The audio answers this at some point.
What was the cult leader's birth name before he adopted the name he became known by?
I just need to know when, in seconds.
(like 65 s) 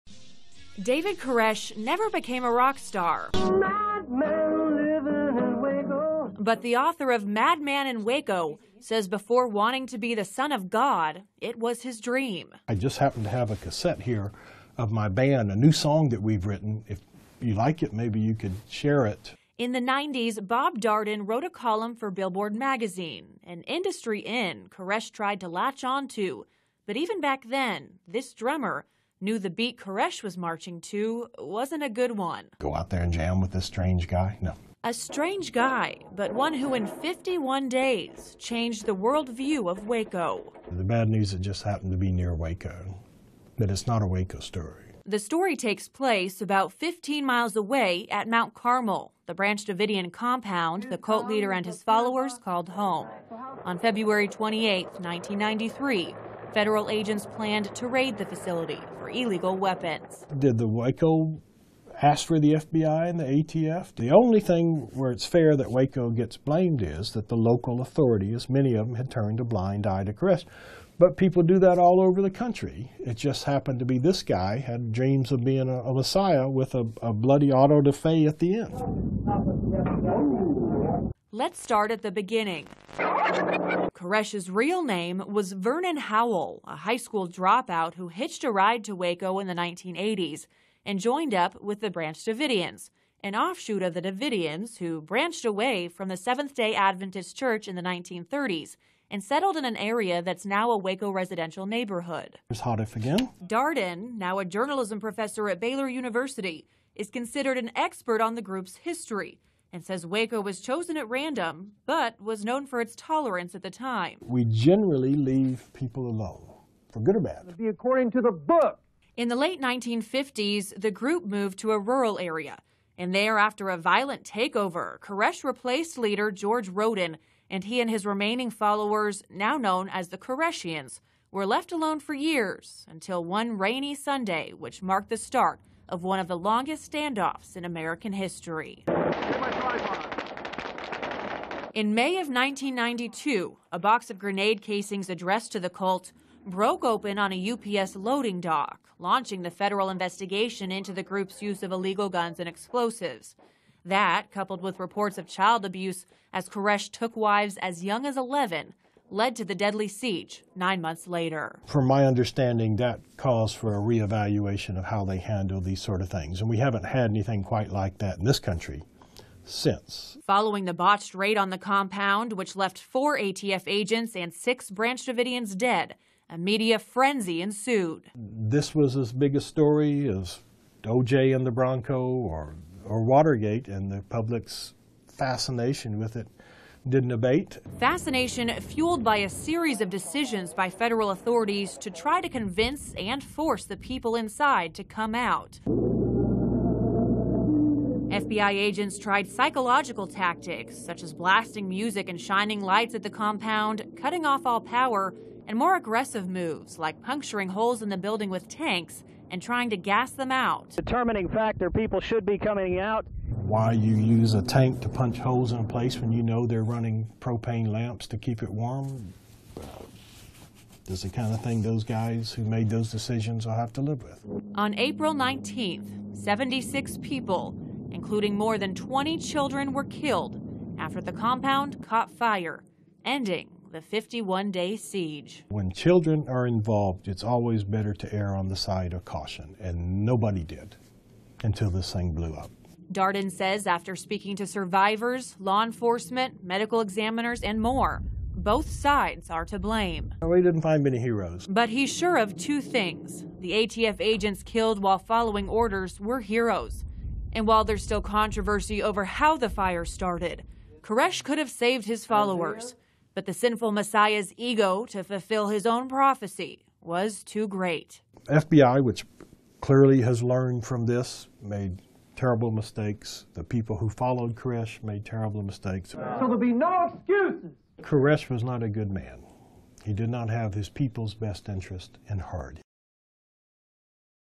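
85 s.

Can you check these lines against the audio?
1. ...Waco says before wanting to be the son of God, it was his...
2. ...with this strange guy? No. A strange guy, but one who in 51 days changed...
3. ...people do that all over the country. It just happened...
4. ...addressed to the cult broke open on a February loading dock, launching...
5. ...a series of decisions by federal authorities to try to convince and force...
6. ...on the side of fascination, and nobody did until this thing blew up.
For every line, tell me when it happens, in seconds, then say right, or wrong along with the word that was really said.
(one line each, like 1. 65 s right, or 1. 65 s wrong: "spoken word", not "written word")
1. 8 s right
2. 33 s right
3. 71 s right
4. 145 s wrong: "UPS", not "February"
5. 189 s right
6. 238 s wrong: "caution", not "fascination".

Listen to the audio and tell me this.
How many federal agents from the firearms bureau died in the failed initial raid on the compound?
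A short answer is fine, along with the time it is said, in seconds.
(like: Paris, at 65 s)
4, at 172 s.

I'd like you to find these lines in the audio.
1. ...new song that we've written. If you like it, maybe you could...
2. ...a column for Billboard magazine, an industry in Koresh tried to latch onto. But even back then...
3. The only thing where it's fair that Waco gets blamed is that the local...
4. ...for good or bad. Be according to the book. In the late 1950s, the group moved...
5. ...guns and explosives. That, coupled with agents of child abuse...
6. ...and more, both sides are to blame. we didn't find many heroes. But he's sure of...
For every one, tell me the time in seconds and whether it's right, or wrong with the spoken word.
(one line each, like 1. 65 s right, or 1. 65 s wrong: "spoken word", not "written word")
1. 15 s right
2. 21 s right
3. 63 s right
4. 116 s right
5. 152 s wrong: "reports", not "agents"
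6. 247 s right.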